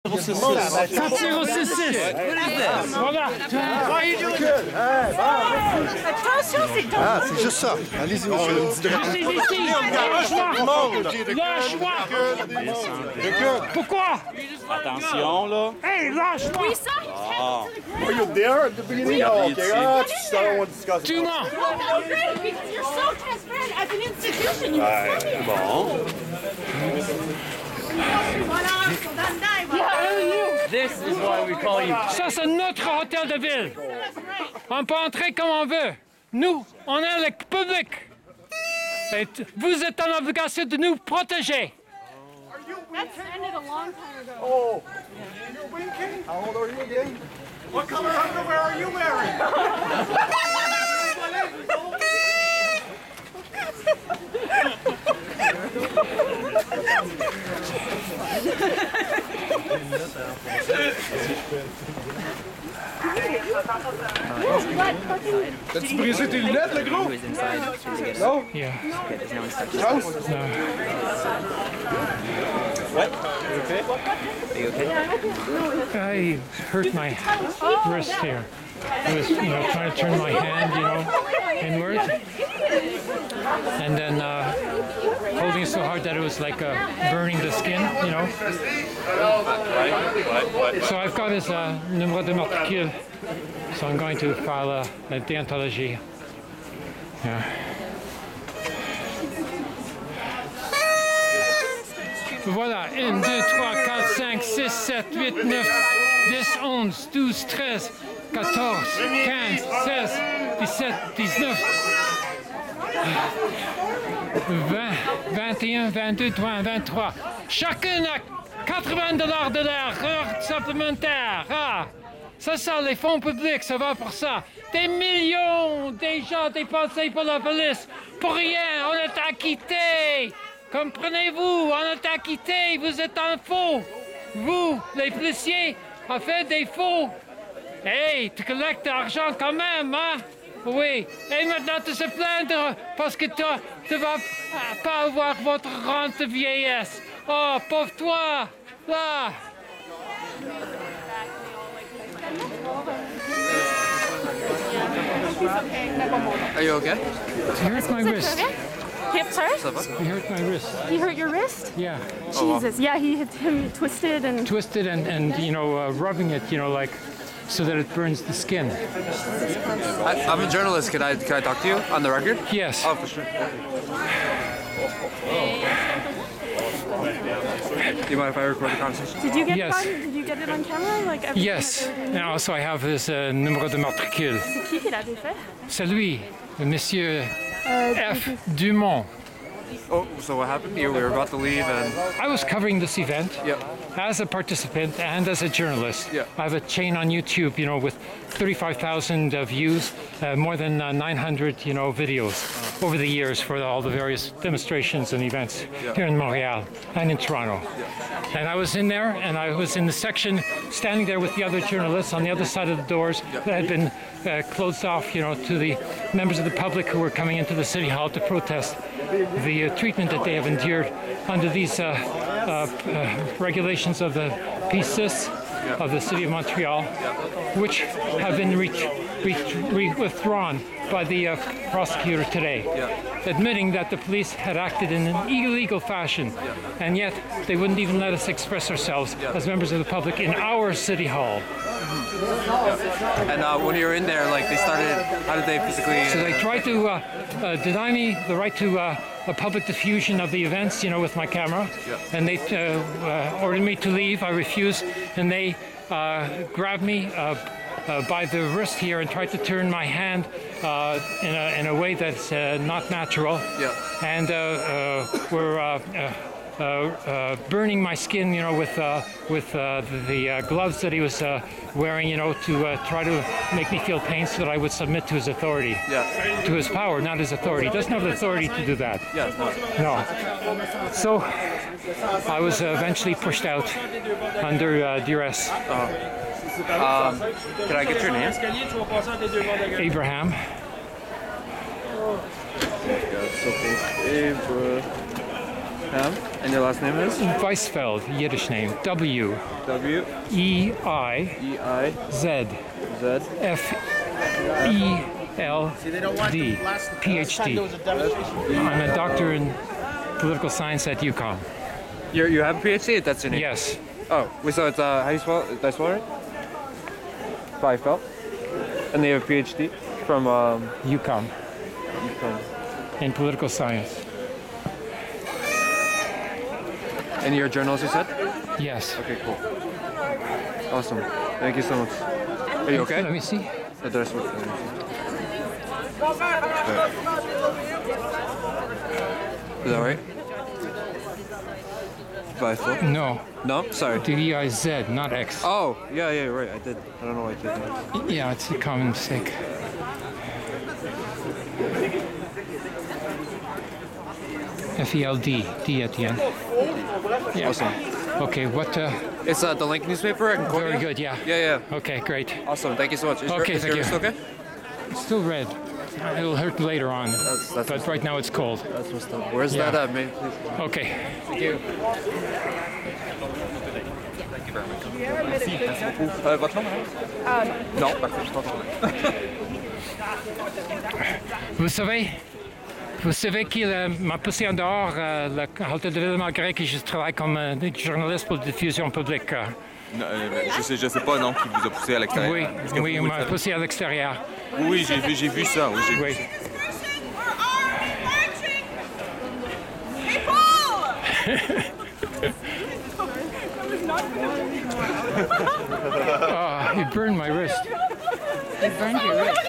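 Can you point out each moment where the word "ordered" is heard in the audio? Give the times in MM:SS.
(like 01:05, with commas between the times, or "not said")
04:13.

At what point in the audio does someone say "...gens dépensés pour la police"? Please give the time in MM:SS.
02:06.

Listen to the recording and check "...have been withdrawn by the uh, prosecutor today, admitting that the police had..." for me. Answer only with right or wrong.
right.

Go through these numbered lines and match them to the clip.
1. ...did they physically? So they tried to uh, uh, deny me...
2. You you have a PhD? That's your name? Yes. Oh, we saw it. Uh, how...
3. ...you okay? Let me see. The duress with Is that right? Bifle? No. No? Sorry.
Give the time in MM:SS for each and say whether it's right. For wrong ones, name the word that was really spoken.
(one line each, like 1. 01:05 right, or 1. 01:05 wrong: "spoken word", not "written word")
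1. 04:05 right
2. 05:12 right
3. 05:32 wrong: "dress", not "duress".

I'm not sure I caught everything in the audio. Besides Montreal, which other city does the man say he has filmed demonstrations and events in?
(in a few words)
Toronto.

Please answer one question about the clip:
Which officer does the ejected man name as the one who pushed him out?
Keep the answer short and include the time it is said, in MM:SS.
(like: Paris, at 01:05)
F. Dumont, at 03:08.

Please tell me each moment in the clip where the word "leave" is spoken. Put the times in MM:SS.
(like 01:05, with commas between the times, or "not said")
03:11, 04:13.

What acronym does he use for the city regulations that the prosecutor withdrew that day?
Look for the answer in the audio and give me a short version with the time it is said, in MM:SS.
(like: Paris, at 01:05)
PCIS, at 03:44.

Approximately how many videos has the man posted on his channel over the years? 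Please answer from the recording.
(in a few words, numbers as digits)
900.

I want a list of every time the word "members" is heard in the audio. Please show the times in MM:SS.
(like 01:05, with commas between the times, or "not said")
03:36, 03:59.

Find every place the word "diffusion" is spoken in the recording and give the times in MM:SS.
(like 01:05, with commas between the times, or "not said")
04:09, 06:28.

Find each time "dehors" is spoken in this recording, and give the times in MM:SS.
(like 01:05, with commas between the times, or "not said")
06:24.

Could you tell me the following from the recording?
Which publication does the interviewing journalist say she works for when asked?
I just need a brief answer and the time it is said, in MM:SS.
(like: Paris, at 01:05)
The Link, at 05:59.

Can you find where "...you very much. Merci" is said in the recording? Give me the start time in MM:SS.
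06:14.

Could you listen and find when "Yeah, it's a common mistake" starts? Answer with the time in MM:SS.
05:48.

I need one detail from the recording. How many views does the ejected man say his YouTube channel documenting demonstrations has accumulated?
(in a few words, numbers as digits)
35,000.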